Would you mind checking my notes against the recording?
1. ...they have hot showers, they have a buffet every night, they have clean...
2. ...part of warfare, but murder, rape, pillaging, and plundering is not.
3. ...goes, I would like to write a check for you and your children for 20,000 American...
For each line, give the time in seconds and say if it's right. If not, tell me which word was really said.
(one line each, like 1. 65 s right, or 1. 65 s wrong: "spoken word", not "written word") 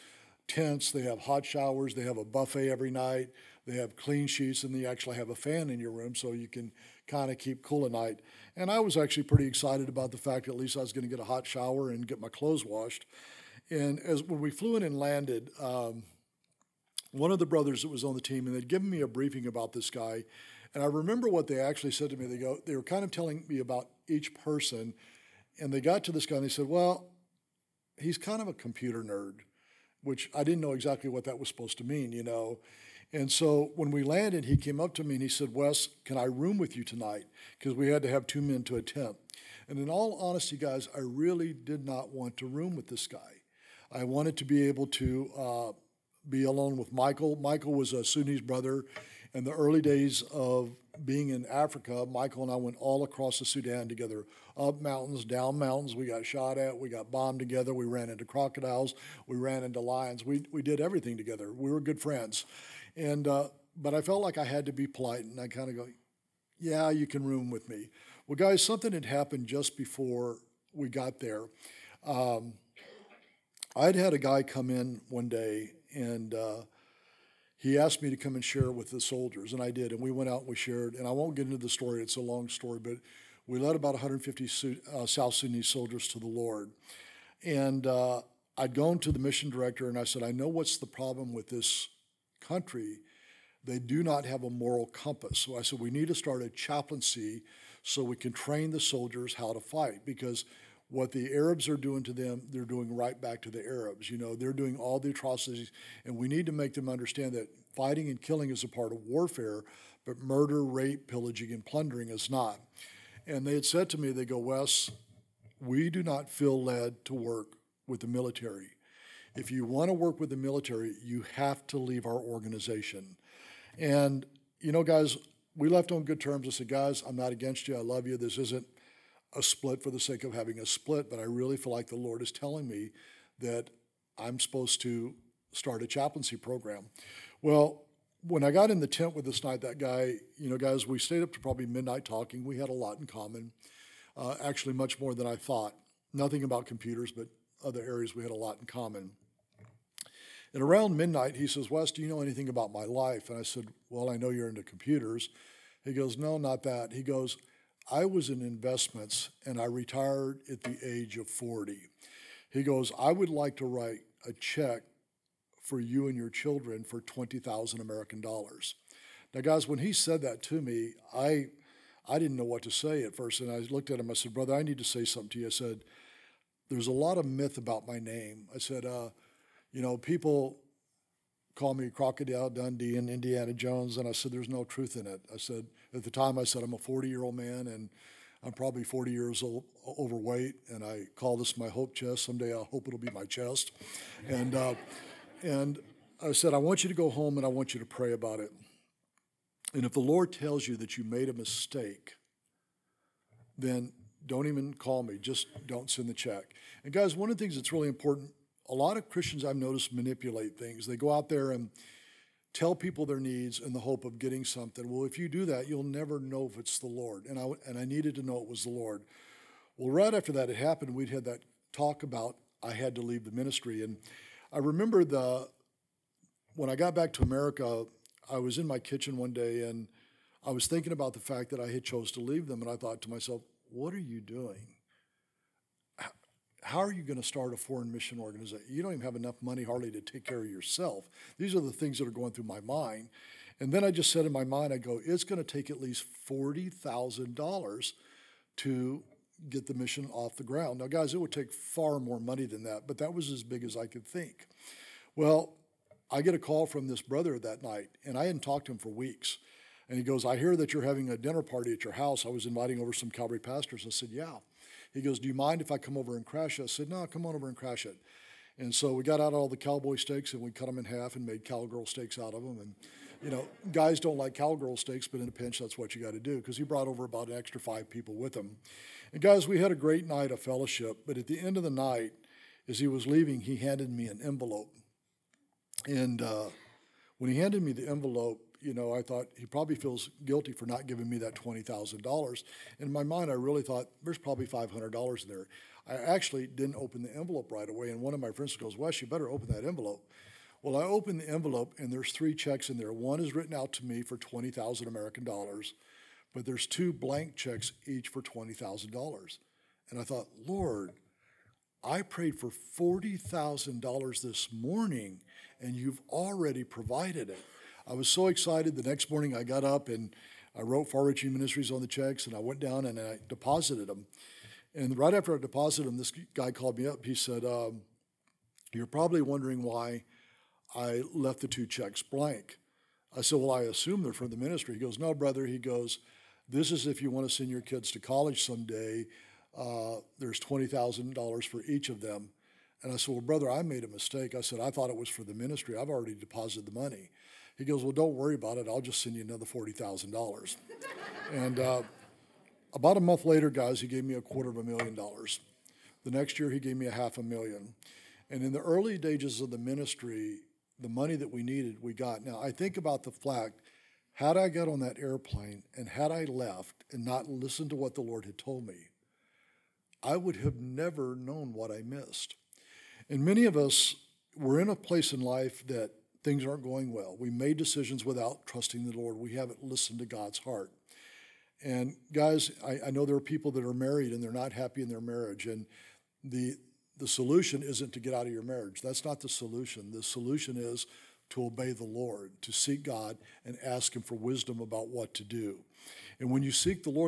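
1. 0 s right
2. 108 s right
3. 162 s right.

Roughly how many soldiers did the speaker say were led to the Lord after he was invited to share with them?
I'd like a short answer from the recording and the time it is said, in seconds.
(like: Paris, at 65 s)
150, at 83 s.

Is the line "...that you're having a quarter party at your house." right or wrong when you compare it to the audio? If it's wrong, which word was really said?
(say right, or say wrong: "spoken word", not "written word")
wrong: "dinner", not "quarter".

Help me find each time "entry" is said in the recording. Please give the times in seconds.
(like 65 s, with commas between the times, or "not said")
not said.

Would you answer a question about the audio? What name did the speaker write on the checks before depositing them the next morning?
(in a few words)
Far Reaching Ministries.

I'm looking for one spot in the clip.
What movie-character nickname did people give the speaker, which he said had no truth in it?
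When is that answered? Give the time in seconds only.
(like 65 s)
181 s.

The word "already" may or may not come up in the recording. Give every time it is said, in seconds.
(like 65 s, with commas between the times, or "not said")
316 s, 345 s.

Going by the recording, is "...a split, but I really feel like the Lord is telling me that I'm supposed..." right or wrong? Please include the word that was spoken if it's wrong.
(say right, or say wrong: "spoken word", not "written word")
right.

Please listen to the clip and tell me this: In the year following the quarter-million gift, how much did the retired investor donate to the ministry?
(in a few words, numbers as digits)
half a million.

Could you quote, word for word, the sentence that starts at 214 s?
Well, if you do that, you'll never know if it's the Lord.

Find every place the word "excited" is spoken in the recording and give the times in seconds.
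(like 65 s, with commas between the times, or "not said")
9 s, 318 s.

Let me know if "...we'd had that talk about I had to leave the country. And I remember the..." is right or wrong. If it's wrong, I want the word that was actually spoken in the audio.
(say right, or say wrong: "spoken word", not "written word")
wrong: "ministry", not "country".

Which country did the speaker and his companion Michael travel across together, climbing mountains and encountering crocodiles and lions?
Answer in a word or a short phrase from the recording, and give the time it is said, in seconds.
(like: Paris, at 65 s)
Sudan, at 53 s.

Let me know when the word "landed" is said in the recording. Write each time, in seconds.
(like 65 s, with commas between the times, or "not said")
14 s, 34 s.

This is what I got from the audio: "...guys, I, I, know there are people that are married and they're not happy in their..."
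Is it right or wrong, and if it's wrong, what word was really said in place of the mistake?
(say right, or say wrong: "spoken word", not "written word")
right.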